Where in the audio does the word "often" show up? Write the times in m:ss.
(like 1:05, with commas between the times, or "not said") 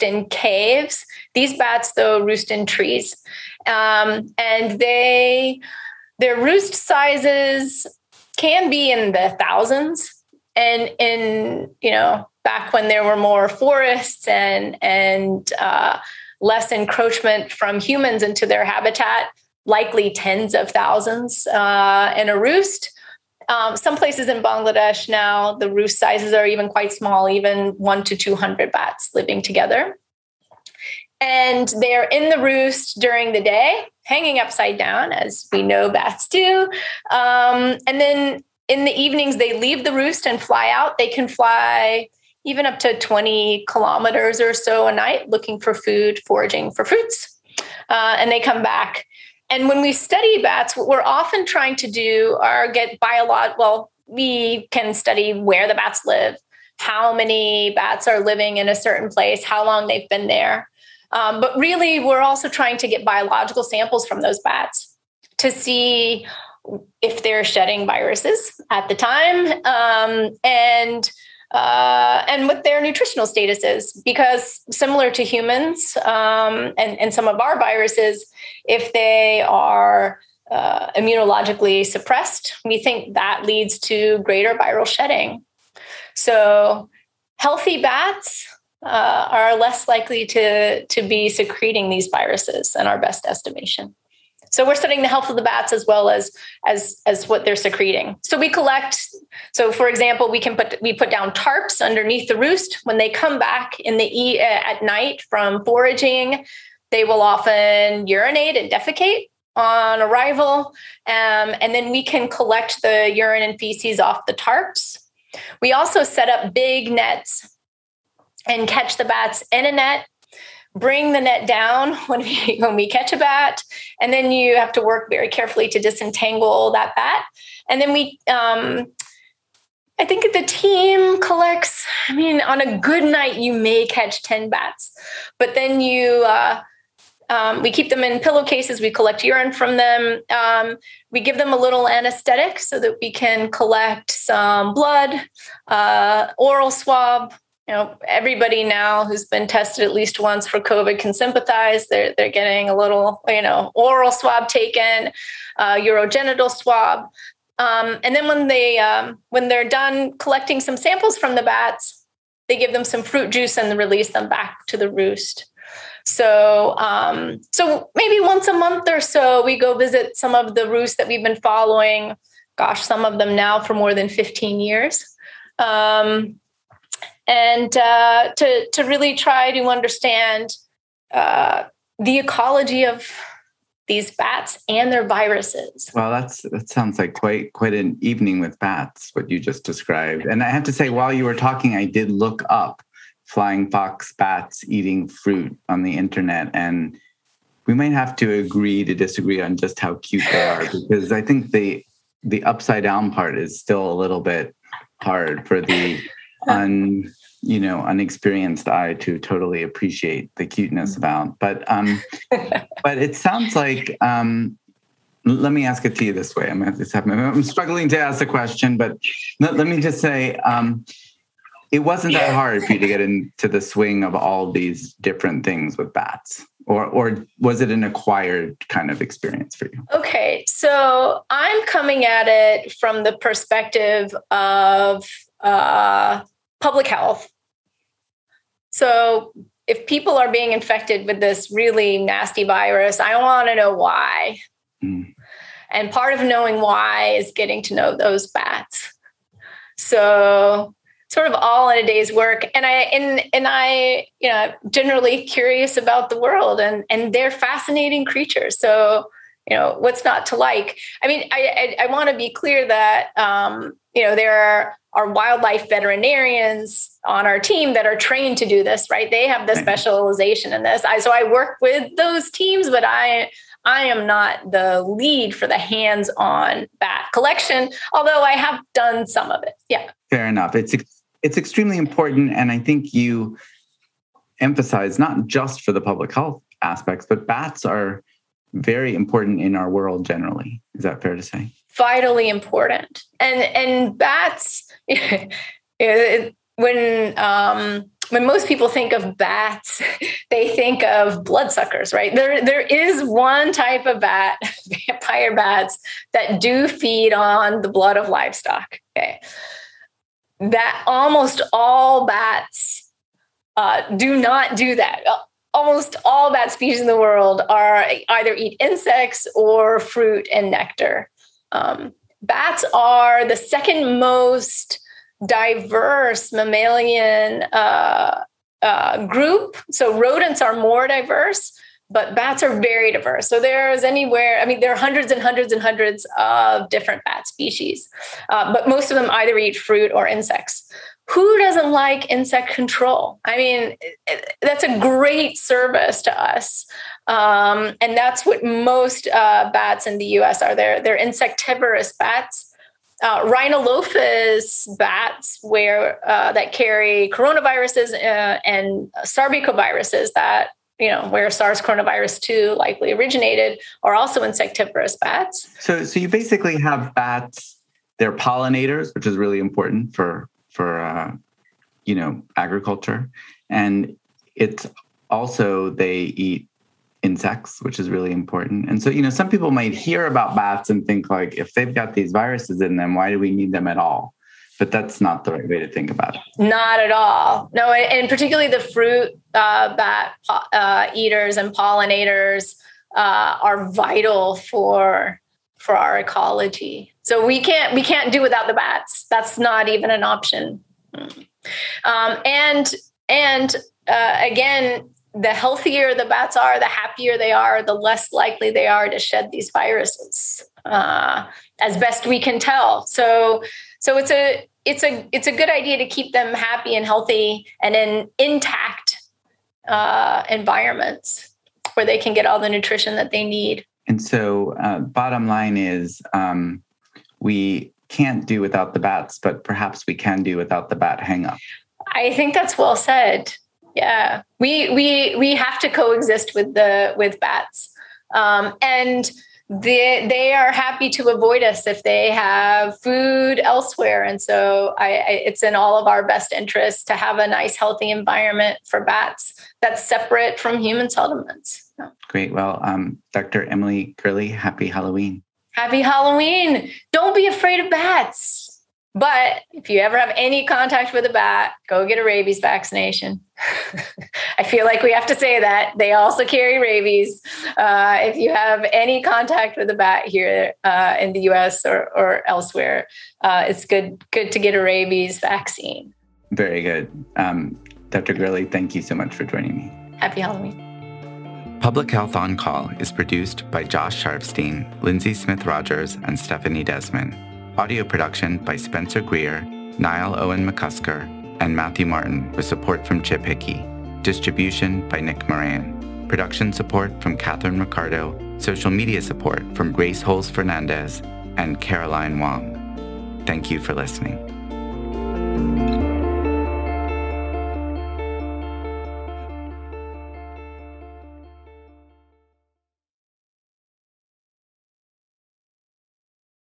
0:51, 1:47.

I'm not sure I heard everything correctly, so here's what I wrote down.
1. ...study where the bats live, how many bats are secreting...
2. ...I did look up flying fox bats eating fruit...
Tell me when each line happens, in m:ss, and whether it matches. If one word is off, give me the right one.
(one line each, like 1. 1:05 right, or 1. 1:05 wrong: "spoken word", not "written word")
1. 0:54 wrong: "living", not "secreting"
2. 3:11 right.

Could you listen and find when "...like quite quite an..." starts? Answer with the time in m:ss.
3:06.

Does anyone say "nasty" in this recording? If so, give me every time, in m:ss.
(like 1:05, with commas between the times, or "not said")
4:01.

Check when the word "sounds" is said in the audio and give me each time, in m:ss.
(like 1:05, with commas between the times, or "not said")
3:06, 3:33.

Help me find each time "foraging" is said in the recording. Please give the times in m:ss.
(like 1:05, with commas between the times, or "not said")
0:46, 1:45.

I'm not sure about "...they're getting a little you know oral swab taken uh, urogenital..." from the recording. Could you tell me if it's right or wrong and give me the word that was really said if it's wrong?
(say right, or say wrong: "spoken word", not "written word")
right.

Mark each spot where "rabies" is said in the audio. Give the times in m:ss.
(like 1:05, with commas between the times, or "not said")
7:42, 7:46, 7:54.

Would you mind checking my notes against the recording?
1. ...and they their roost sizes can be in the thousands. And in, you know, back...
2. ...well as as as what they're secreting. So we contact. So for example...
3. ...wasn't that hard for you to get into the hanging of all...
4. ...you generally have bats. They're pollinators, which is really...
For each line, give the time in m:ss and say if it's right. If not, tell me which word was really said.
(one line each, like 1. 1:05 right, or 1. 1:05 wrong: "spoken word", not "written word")
1. 0:04 right
2. 1:35 wrong: "collect", not "contact"
3. 3:41 wrong: "swing", not "hanging"
4. 6:05 wrong: "basically", not "generally".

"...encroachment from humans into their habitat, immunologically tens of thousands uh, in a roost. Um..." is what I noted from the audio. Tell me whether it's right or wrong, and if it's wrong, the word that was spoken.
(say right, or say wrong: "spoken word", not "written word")
wrong: "likely", not "immunologically".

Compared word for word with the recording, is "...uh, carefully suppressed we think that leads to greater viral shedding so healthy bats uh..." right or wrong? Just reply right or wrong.
wrong.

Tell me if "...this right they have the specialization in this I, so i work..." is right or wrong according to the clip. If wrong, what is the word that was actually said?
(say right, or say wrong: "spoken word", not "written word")
right.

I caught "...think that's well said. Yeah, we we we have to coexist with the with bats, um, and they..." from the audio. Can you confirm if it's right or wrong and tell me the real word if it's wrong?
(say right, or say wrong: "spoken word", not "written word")
right.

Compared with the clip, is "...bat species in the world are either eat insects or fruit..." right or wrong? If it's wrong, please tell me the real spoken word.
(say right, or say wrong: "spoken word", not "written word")
right.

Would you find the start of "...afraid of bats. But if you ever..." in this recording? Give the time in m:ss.
7:37.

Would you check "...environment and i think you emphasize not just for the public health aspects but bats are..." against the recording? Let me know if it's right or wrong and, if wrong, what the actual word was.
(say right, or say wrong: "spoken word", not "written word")
wrong: "important", not "environment".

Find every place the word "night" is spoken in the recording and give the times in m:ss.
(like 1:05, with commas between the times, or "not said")
0:44, 1:44, 2:13.